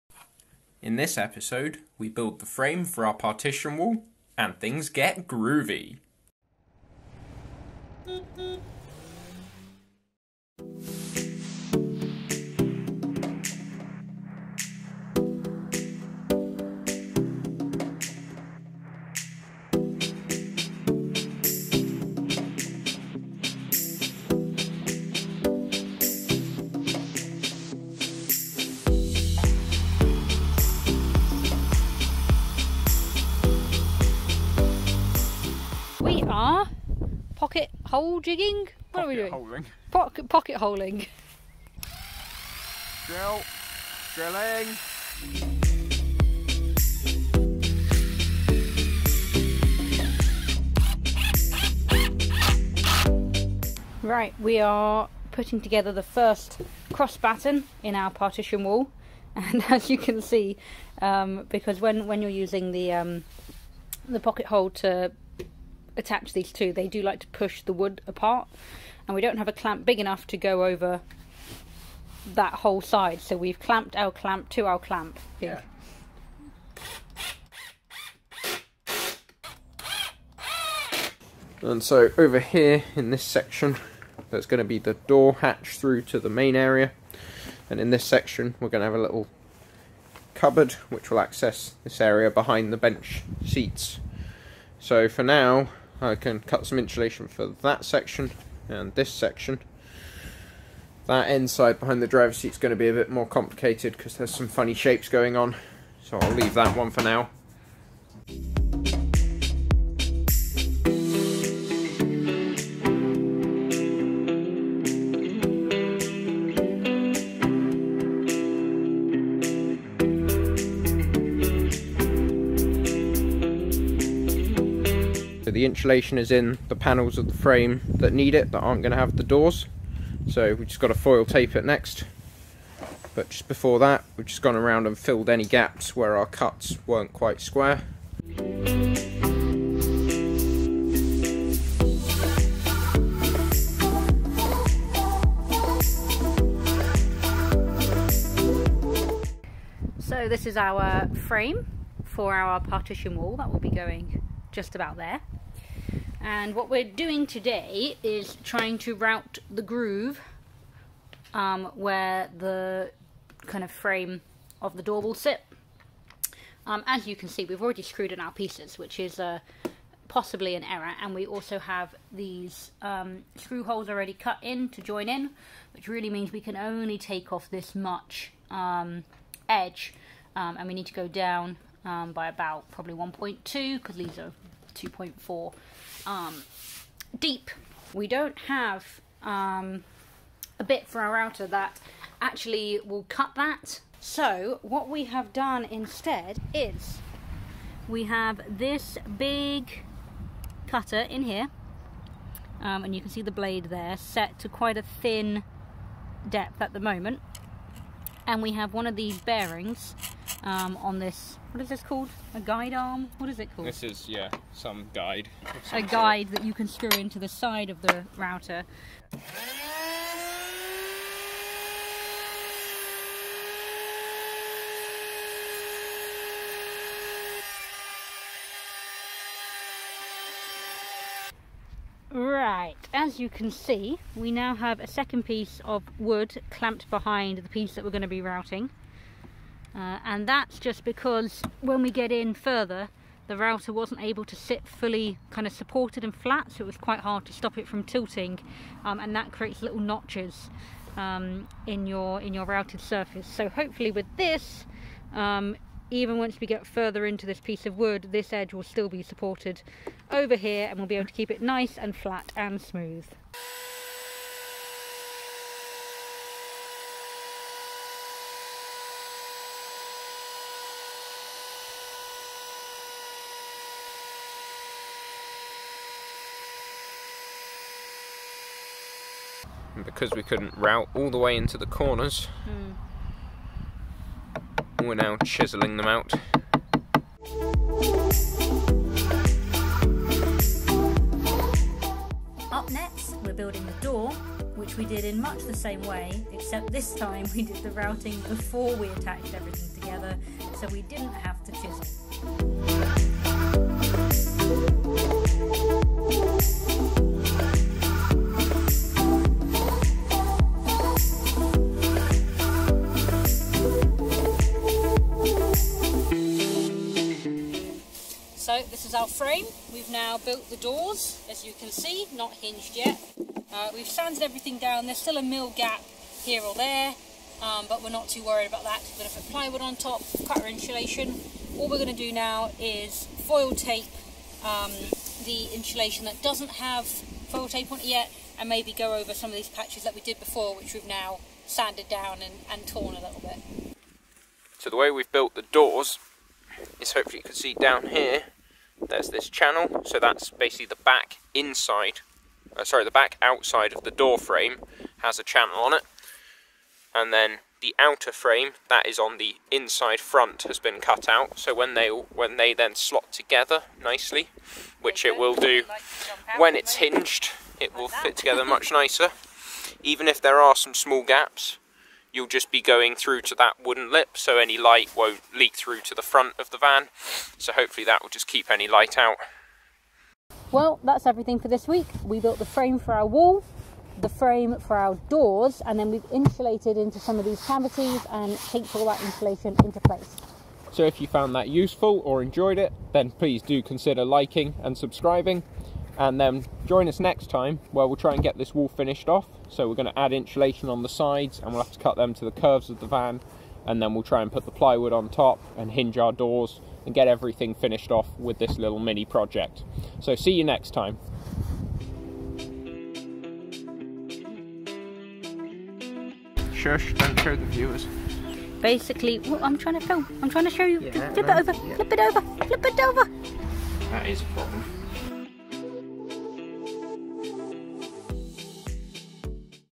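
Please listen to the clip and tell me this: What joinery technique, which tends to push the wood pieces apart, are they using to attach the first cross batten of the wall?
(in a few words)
Pocket holing.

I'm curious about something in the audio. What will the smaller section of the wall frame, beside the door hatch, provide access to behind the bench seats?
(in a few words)
A little cupboard.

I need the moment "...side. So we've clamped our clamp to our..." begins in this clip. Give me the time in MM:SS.
01:12.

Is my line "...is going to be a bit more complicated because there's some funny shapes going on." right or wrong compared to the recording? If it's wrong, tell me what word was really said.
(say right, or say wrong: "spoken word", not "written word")
right.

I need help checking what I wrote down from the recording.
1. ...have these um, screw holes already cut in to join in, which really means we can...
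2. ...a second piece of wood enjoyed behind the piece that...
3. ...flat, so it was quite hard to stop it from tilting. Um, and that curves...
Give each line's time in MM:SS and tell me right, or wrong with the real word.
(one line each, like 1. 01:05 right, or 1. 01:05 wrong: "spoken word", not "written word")
1. 02:51 right
2. 03:54 wrong: "clamped", not "enjoyed"
3. 04:06 wrong: "creates", not "curves".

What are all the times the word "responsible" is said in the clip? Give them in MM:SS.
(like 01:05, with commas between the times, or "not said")
not said.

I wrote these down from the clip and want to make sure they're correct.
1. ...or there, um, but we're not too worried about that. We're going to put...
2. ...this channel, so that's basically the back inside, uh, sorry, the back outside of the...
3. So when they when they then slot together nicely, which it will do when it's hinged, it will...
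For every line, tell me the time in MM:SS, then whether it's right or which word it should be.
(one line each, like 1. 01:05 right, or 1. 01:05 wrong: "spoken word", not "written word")
1. 05:26 right
2. 05:49 right
3. 06:01 right.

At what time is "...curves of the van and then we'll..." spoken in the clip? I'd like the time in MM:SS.
06:42.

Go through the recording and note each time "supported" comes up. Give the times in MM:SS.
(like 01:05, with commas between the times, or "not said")
04:05, 04:19.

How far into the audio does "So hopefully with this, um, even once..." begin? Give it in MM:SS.
04:13.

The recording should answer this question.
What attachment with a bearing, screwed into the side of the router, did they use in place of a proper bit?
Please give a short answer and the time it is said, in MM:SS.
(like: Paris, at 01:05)
A guide arm, at 03:32.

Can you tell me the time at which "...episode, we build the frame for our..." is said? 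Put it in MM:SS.
00:01.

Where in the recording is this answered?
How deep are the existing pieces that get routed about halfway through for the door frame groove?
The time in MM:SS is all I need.
03:04.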